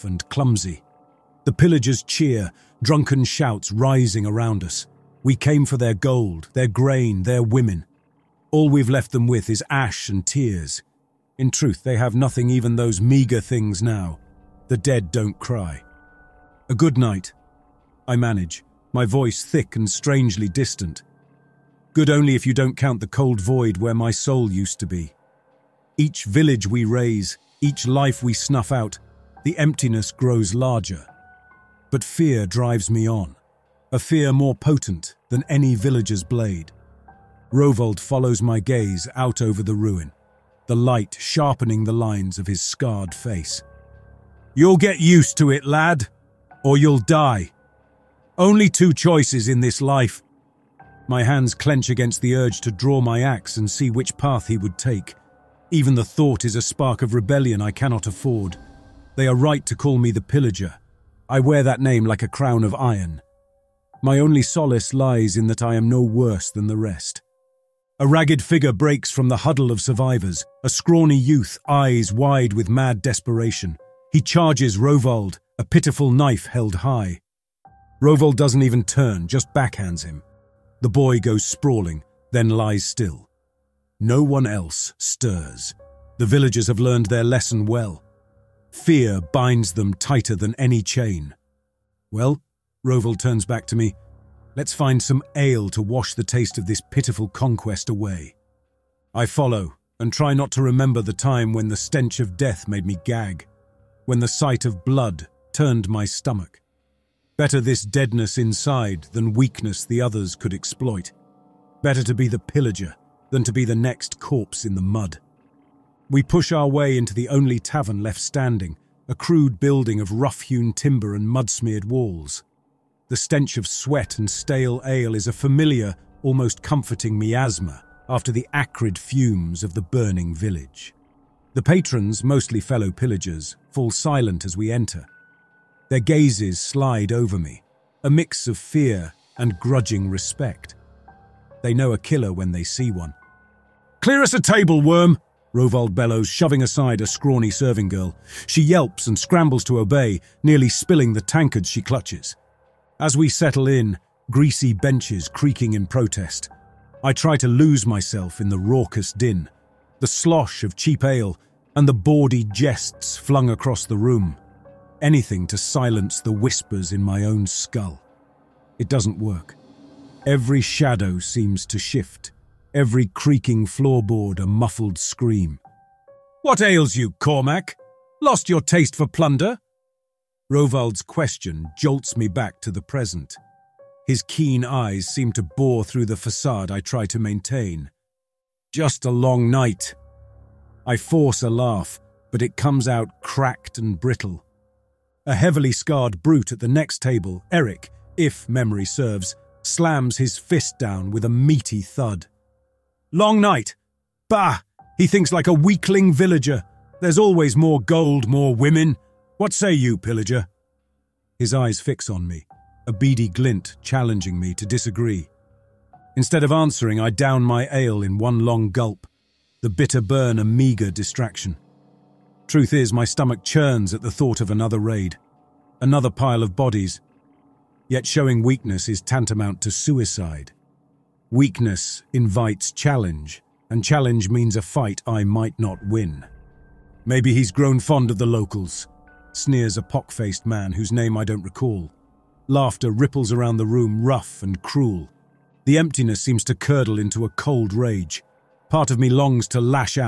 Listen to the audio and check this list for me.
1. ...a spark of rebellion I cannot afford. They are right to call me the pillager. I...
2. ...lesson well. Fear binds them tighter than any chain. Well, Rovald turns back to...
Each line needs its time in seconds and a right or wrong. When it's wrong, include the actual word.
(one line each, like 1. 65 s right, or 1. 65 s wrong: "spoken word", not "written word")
1. 56 s right
2. 87 s right.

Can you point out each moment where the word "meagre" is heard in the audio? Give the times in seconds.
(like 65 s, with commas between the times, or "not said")
13 s, 220 s.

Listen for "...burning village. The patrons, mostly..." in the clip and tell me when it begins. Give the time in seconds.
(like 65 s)
129 s.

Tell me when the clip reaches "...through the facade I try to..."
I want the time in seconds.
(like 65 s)
185 s.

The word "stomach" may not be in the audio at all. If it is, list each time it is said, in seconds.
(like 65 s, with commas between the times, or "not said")
106 s, 223 s.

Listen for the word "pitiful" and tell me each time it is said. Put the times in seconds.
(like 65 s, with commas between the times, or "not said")
75 s, 96 s.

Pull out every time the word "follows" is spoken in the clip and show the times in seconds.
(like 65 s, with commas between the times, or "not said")
37 s, 99 s.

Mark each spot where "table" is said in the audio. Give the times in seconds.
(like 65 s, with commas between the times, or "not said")
144 s, 197 s.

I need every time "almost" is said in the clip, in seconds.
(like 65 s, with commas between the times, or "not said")
126 s.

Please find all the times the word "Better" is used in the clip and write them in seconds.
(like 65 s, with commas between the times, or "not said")
107 s, 111 s.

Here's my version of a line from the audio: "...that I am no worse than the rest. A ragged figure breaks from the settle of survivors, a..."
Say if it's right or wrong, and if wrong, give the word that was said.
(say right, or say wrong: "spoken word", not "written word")
wrong: "huddle", not "settle".